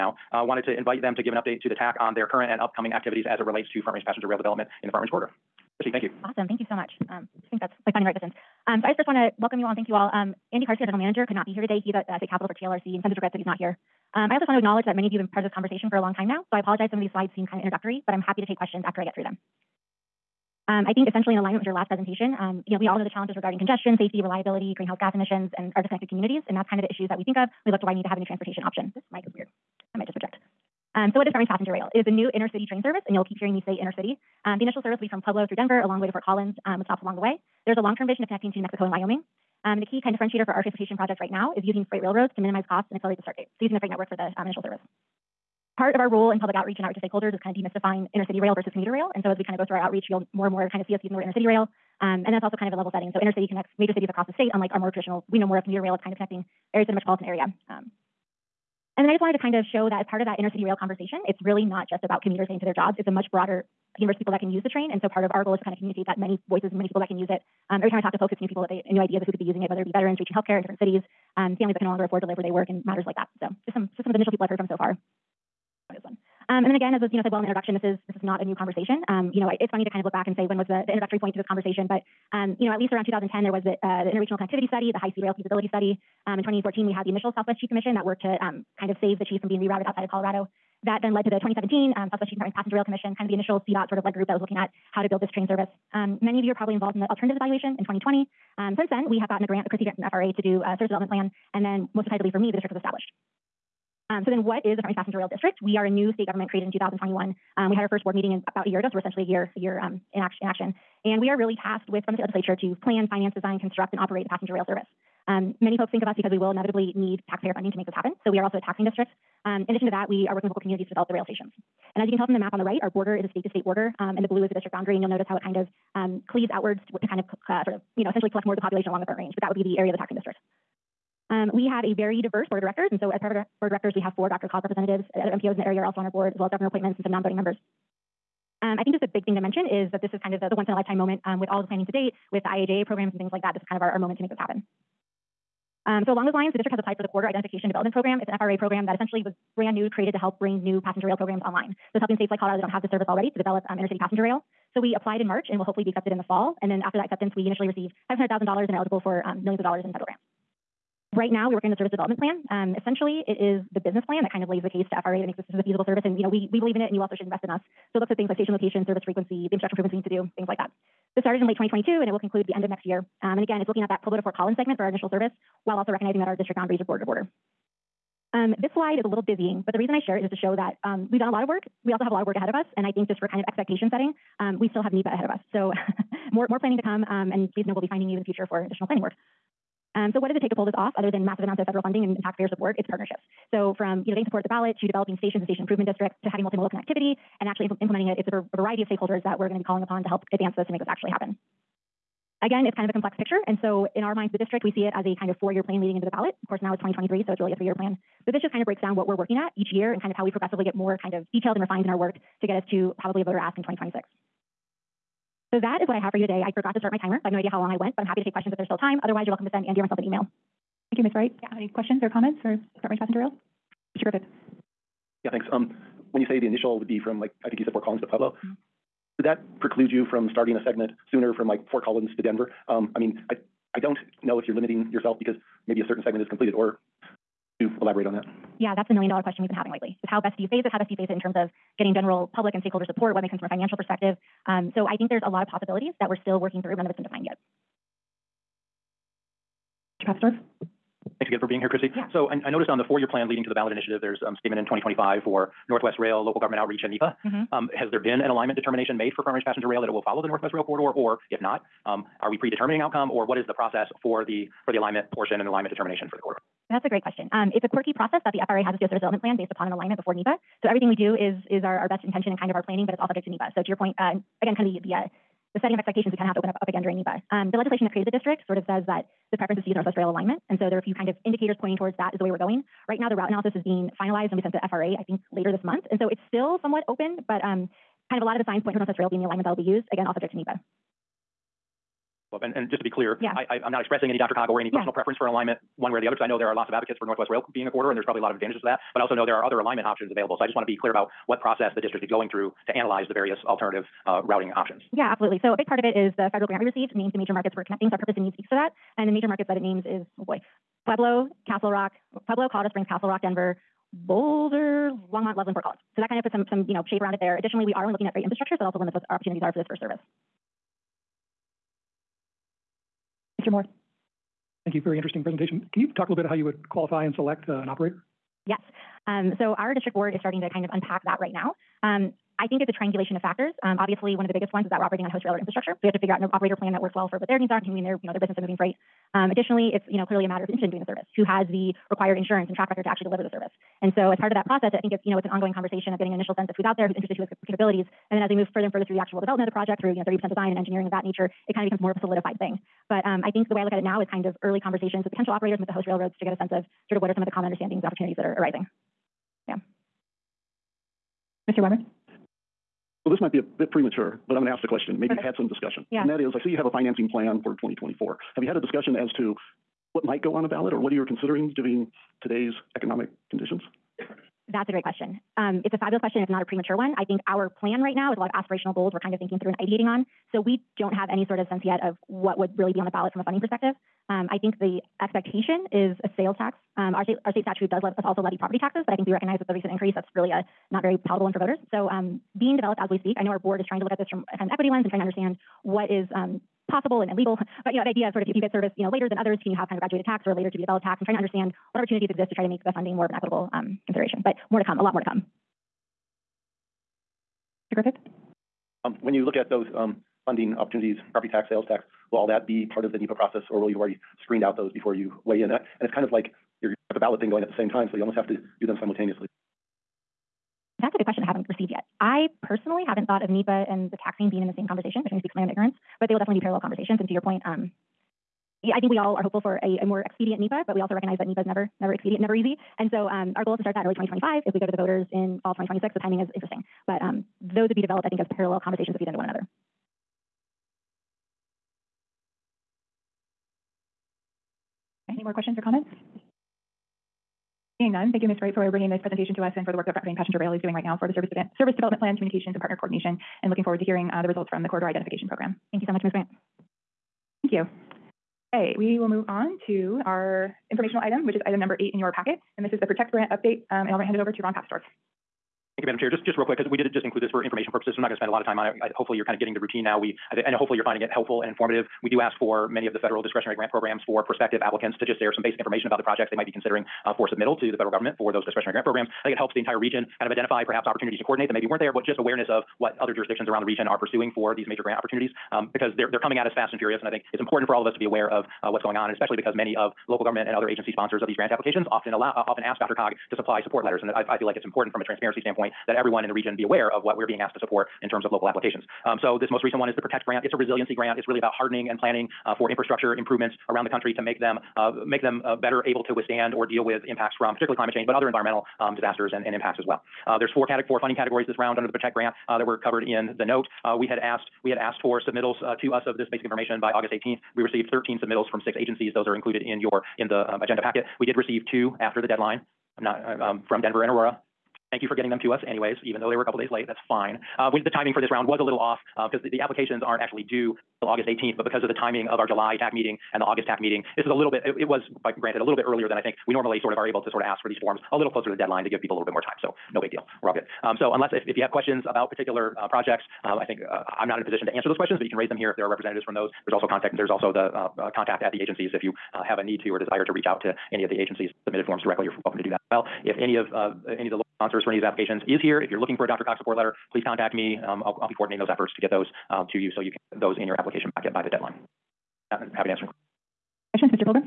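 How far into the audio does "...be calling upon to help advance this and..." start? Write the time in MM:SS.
03:19.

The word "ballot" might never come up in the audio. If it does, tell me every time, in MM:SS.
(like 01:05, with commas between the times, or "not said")
03:14, 03:26, 04:13, 06:10, 06:22, 06:56.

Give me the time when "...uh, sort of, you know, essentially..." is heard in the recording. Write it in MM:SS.
02:07.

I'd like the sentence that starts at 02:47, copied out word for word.
So it looks at things like station location, service frequency, the infrastructure improvements we need to do, things like that.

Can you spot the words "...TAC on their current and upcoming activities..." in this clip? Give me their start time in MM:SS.
00:01.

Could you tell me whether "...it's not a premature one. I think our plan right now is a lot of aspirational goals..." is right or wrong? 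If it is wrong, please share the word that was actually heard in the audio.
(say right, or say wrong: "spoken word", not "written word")
right.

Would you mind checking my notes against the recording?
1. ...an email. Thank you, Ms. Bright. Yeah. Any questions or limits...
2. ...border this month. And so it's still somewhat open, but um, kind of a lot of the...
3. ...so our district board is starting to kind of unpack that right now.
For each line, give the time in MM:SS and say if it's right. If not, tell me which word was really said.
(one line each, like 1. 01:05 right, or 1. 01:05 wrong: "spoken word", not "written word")
1. 03:39 wrong: "comments", not "limits"
2. 04:45 wrong: "later", not "border"
3. 05:29 right.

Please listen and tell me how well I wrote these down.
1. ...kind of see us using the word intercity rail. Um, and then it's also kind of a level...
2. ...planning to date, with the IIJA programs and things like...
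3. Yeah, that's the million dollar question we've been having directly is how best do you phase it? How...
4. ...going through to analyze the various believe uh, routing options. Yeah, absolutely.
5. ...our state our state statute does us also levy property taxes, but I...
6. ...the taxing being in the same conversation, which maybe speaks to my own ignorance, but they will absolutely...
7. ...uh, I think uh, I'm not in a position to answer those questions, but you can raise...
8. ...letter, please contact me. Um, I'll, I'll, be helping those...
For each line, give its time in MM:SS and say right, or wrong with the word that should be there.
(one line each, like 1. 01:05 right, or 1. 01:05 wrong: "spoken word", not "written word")
1. 00:50 right
2. 02:21 right
3. 03:58 wrong: "lately", not "directly"
4. 05:02 wrong: "alternative", not "believe"
5. 06:26 right
6. 07:03 wrong: "definitely", not "absolutely"
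7. 09:03 right
8. 09:16 wrong: "coordinating", not "helping".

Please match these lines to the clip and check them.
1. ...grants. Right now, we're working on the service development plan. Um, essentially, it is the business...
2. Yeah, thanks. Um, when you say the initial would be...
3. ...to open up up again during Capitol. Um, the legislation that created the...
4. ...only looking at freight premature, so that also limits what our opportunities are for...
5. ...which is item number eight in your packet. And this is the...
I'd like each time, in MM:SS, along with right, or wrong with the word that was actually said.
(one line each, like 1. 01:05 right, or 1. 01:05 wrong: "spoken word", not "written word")
1. 02:40 right
2. 03:45 right
3. 04:36 wrong: "NEPA", not "Capitol"
4. 05:17 wrong: "infrastructure", not "premature"
5. 07:41 right.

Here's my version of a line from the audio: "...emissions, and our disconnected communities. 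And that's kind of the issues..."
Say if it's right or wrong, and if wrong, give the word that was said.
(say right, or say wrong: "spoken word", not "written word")
right.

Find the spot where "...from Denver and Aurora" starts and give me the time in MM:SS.
08:43.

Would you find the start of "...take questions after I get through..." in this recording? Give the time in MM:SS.
00:18.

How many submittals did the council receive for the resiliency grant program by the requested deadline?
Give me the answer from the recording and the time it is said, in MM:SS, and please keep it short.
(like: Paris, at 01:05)
13, at 08:37.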